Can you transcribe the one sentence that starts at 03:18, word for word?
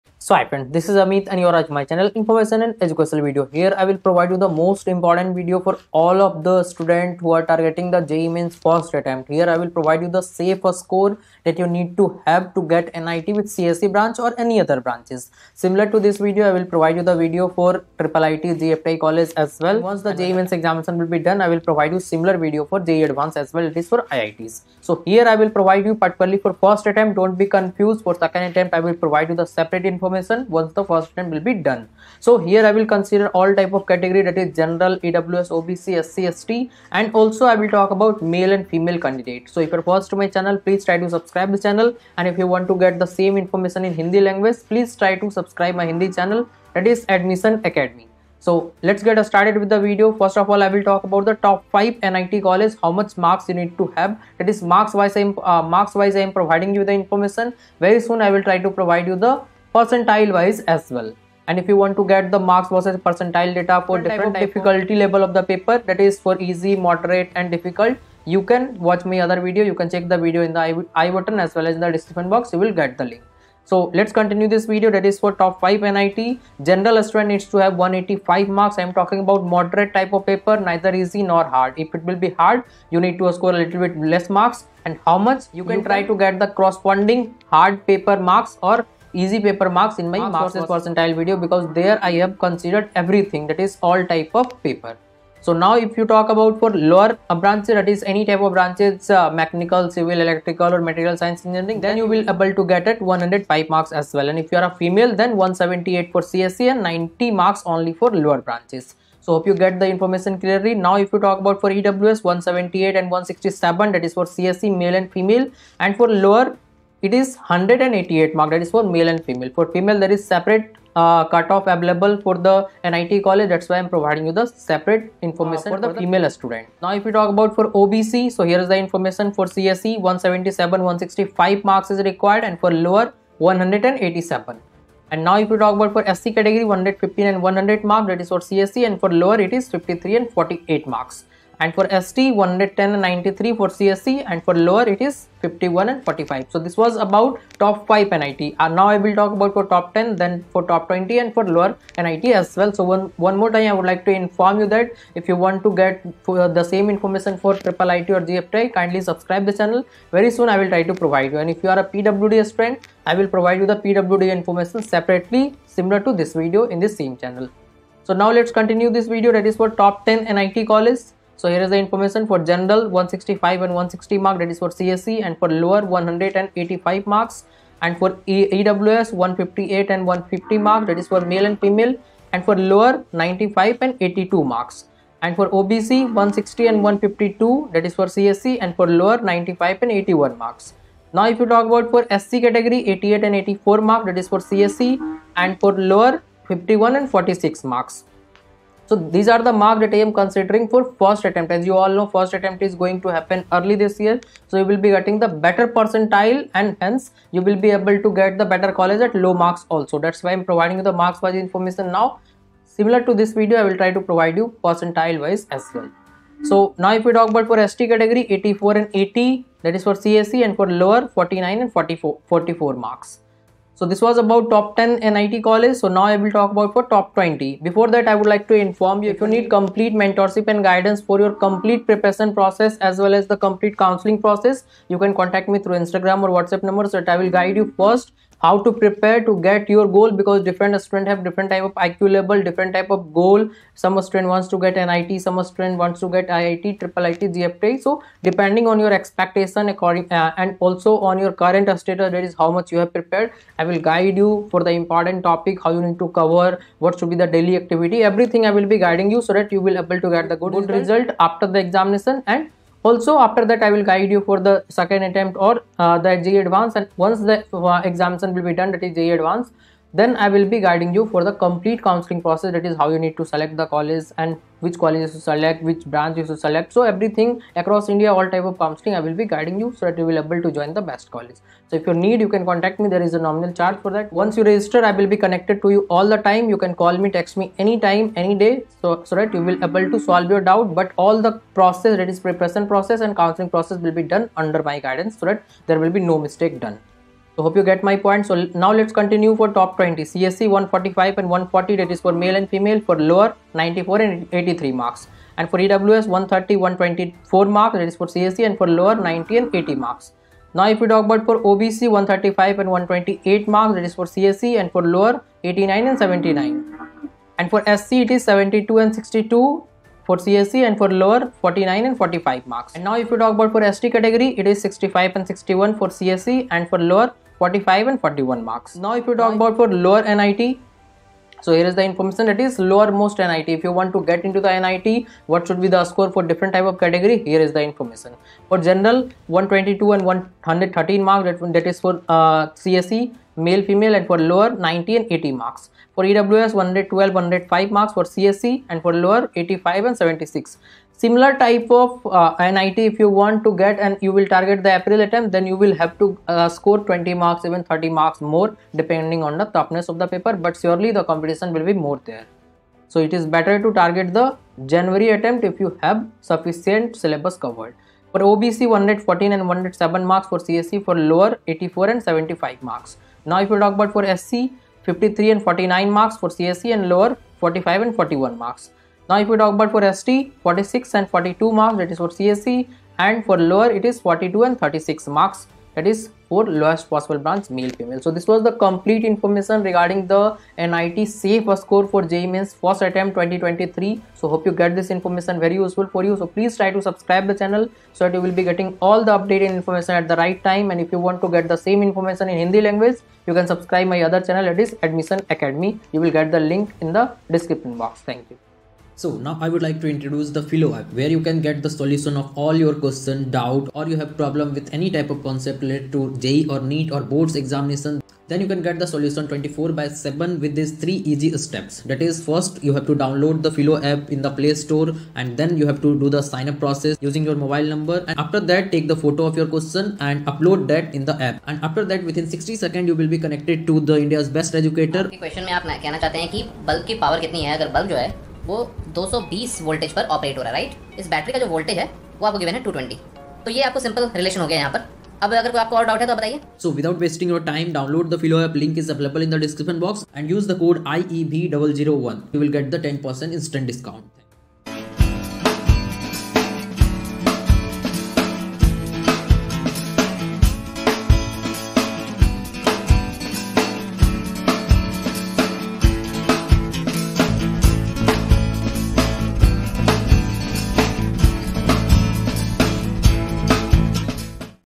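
So these are the that I am considering for first attempt.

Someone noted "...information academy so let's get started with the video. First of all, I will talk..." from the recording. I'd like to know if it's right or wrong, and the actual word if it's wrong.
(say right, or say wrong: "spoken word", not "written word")
wrong: "admission", not "information".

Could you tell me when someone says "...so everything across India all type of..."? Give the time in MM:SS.
04:36.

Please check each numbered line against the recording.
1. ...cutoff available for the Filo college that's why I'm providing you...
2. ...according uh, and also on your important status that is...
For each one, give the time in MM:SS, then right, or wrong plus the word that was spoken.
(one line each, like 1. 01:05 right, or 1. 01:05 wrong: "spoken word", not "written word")
1. 02:01 wrong: "NIT", not "Filo"
2. 04:09 wrong: "current", not "important".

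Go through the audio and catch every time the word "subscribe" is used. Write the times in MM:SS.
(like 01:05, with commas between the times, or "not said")
00:41, 00:45, 02:39, 06:36, 06:43.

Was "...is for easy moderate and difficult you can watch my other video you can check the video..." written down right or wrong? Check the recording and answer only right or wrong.
right.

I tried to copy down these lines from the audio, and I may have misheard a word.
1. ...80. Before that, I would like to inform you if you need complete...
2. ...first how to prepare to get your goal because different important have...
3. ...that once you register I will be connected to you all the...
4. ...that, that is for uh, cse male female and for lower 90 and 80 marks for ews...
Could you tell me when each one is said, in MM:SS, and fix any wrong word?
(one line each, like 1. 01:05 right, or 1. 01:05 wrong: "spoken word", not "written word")
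1. 03:47 wrong: "20", not "80"
2. 03:57 wrong: "student", not "important"
3. 04:43 right
4. 05:41 right.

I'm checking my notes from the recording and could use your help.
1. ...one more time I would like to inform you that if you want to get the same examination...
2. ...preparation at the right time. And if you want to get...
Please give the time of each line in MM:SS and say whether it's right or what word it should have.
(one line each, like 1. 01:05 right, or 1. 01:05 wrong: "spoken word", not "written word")
1. 02:33 wrong: "information", not "examination"
2. 06:39 wrong: "information", not "preparation".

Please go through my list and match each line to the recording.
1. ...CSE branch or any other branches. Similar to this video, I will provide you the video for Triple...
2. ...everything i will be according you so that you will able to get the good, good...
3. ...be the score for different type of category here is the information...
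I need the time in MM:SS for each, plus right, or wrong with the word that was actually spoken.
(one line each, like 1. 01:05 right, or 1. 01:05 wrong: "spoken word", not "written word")
1. 00:13 right
2. 04:18 wrong: "guiding", not "according"
3. 05:35 right.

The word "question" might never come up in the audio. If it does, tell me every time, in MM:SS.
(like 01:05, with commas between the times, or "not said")
06:52, 07:09, 07:15.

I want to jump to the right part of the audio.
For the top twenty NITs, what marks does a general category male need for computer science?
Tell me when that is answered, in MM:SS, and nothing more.
05:00.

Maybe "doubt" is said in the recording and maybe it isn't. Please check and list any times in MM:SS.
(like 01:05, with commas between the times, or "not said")
04:50, 06:53.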